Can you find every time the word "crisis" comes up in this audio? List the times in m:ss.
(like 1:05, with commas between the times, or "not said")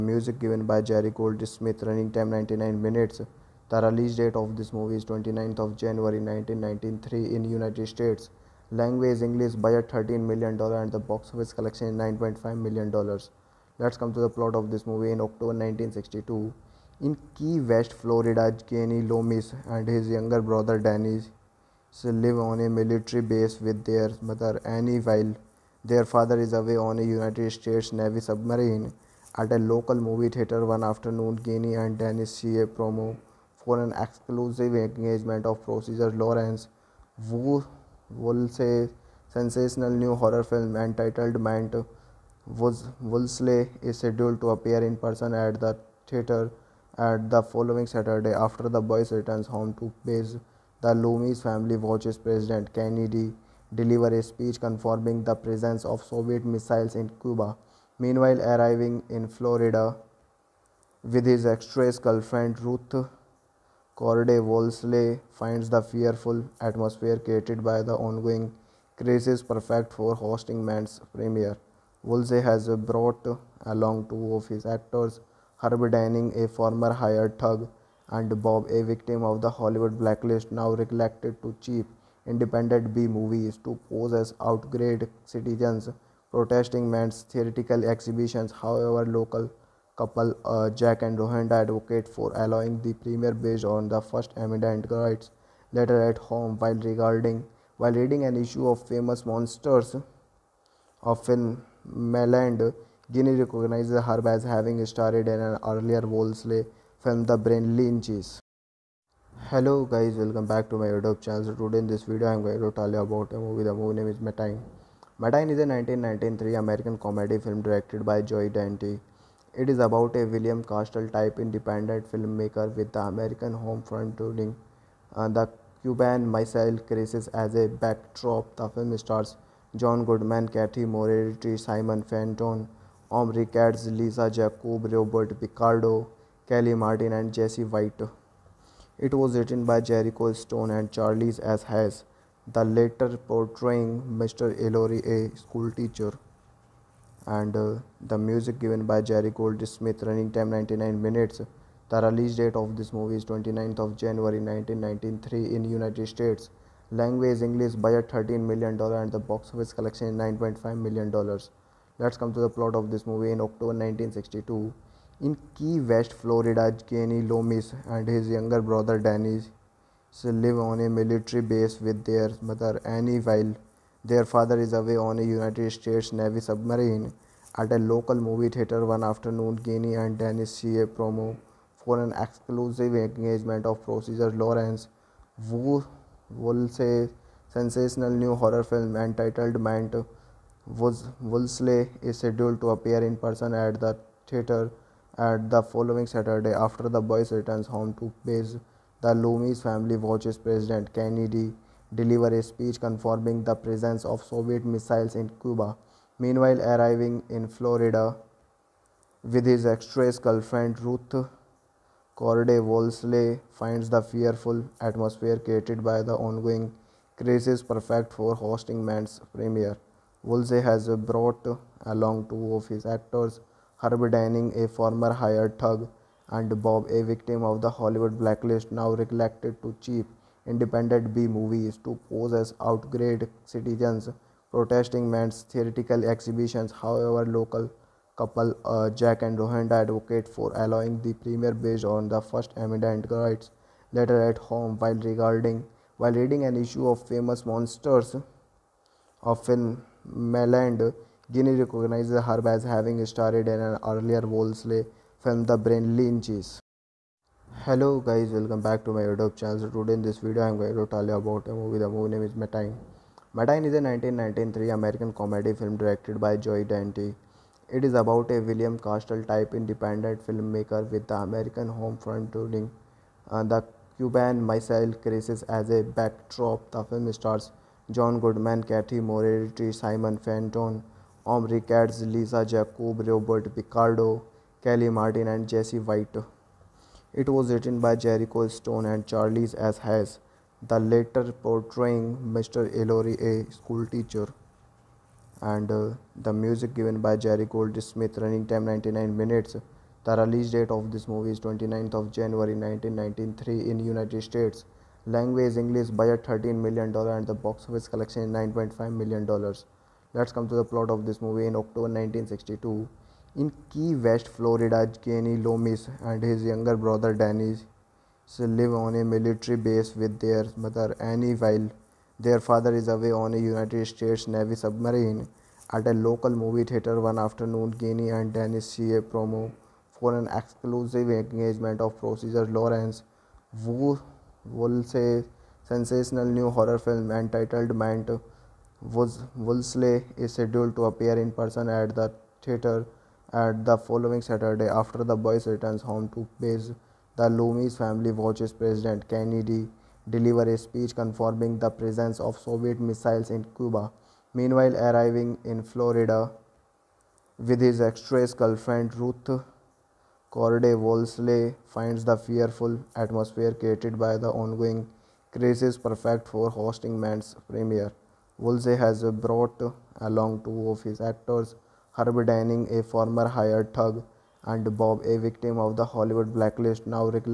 1:08, 2:06, 3:37, 4:34, 6:05.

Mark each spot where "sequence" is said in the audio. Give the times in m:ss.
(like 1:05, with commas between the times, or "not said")
not said.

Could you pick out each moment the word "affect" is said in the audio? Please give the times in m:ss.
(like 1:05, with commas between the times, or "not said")
not said.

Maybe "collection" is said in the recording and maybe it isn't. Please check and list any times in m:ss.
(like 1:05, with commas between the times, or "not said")
0:11, 2:39, 5:07.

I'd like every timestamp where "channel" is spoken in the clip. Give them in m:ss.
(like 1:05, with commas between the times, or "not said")
1:51, 4:19.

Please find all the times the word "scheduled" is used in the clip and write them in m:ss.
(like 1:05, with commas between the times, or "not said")
0:43, 3:12, 5:40.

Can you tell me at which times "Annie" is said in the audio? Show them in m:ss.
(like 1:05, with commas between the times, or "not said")
0:24, 2:52, 5:20.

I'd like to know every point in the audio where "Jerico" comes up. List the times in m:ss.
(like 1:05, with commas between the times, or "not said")
2:19, 4:47.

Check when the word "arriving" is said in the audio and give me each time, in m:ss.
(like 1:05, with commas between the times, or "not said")
0:58, 3:26, 5:54.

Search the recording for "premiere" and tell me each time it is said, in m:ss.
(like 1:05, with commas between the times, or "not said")
1:11, 1:32, 3:39, 4:01, 6:07.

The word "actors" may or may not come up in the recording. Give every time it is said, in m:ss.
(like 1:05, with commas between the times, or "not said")
1:14, 3:42, 6:10.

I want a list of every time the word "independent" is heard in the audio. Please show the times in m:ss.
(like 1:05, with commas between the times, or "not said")
1:22, 2:01, 3:50, 4:29.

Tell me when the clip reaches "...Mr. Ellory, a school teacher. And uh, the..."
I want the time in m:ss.
2:24.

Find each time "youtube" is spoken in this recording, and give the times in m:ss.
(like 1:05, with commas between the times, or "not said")
1:50, 4:19.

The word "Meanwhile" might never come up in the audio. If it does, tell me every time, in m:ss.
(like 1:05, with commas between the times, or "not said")
0:57, 3:26, 5:54.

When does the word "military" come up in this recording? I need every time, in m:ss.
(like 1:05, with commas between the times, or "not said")
0:22, 2:50, 5:19.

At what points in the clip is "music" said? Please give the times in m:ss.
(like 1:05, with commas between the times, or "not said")
2:28, 4:56.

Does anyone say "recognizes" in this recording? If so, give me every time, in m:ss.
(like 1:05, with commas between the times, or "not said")
1:43, 4:11.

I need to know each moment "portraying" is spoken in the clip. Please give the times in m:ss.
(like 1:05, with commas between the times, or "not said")
2:23, 4:51.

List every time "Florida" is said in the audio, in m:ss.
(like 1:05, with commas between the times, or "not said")
0:17, 0:59, 2:46, 3:27, 5:14, 5:55.